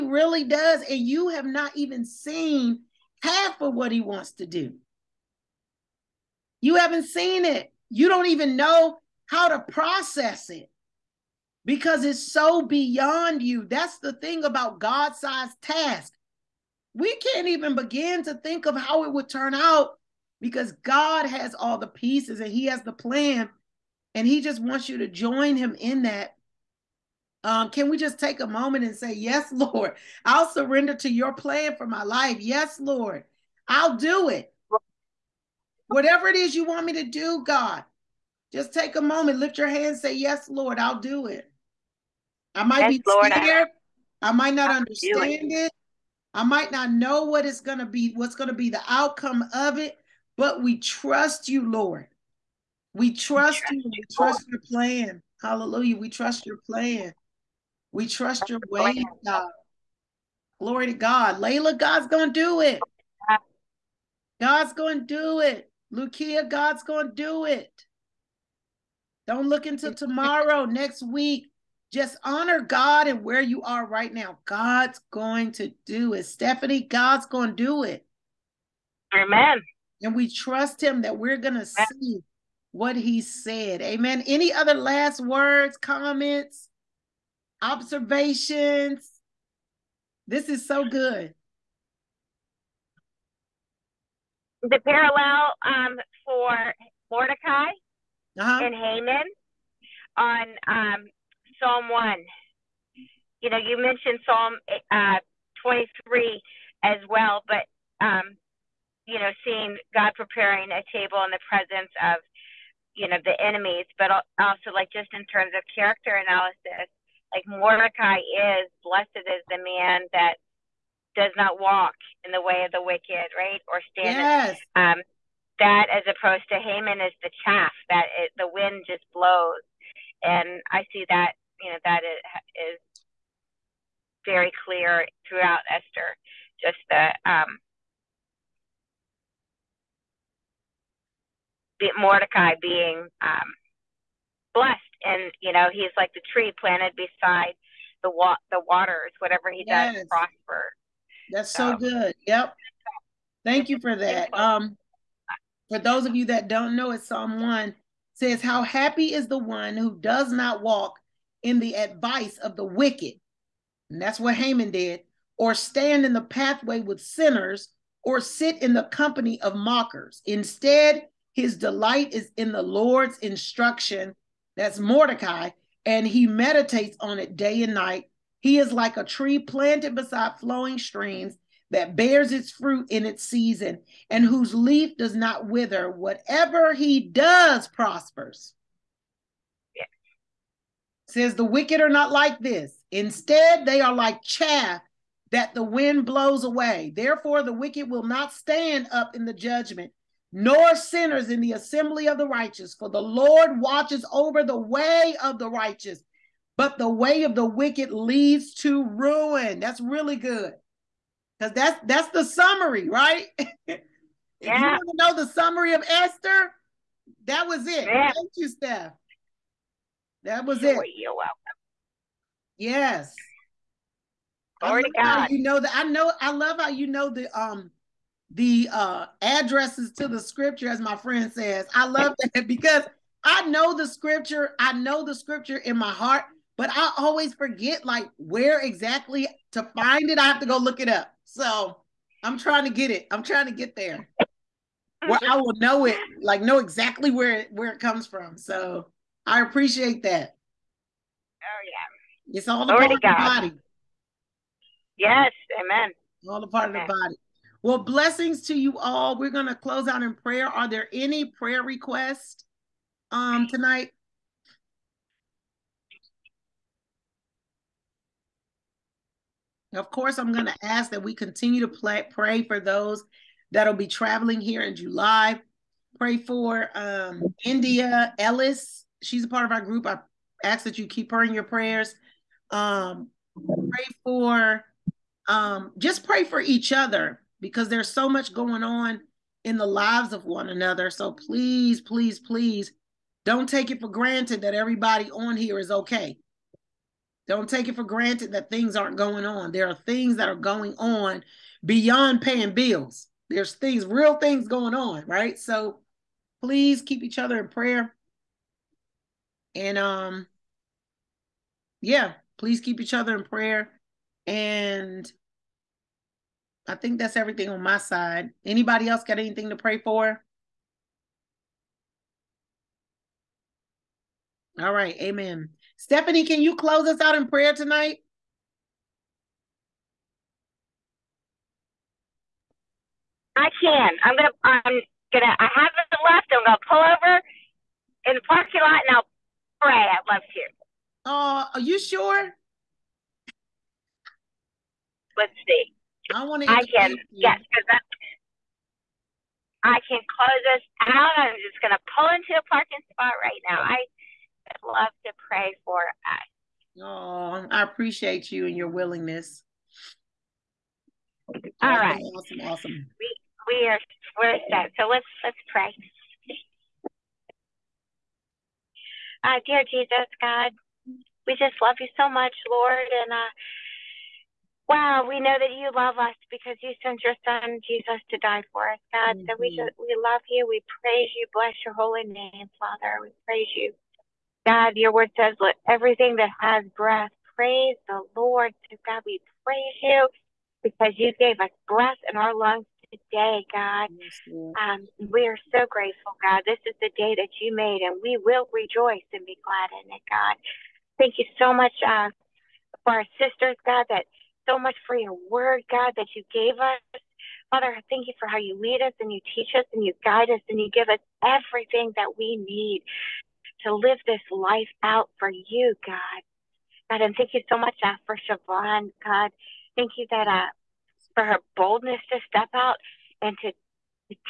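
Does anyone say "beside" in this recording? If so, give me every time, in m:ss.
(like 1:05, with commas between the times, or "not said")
2:26, 2:59.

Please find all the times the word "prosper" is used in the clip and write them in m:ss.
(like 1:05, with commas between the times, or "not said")
2:30, 3:07.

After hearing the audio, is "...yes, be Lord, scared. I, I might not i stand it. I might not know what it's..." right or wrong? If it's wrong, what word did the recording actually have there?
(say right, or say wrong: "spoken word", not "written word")
wrong: "understand", not "stand".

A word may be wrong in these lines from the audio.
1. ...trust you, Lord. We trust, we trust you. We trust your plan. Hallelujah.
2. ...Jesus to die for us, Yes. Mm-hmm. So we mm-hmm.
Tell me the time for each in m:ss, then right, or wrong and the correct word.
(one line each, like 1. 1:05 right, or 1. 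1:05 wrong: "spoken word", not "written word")
1. 0:50 right
2. 6:17 wrong: "God", not "Yes".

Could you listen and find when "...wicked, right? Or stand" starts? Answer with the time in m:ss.
2:02.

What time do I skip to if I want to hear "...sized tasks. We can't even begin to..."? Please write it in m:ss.
0:15.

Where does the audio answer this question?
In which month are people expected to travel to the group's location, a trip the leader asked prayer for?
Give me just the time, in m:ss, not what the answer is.
4:34.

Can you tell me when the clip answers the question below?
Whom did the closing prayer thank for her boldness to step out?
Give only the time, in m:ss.
6:58.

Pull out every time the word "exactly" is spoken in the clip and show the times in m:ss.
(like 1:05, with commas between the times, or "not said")
3:58, 4:06.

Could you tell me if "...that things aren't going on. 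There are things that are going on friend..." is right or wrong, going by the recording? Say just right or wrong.
wrong.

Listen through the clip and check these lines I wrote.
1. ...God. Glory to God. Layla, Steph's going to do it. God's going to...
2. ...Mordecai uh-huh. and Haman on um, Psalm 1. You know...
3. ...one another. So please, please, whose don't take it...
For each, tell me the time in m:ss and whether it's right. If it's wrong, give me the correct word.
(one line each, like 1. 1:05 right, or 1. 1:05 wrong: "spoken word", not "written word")
1. 0:59 wrong: "God", not "Steph"
2. 1:37 right
3. 4:50 wrong: "please", not "whose".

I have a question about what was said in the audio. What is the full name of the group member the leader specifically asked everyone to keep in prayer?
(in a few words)
India Ellis.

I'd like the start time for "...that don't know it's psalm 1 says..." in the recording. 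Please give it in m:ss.
2:36.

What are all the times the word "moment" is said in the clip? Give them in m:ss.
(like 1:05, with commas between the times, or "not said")
0:28, 0:39.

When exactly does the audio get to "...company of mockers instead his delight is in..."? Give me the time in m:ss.
2:48.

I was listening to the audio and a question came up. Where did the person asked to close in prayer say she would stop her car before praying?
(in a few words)
Parking lot.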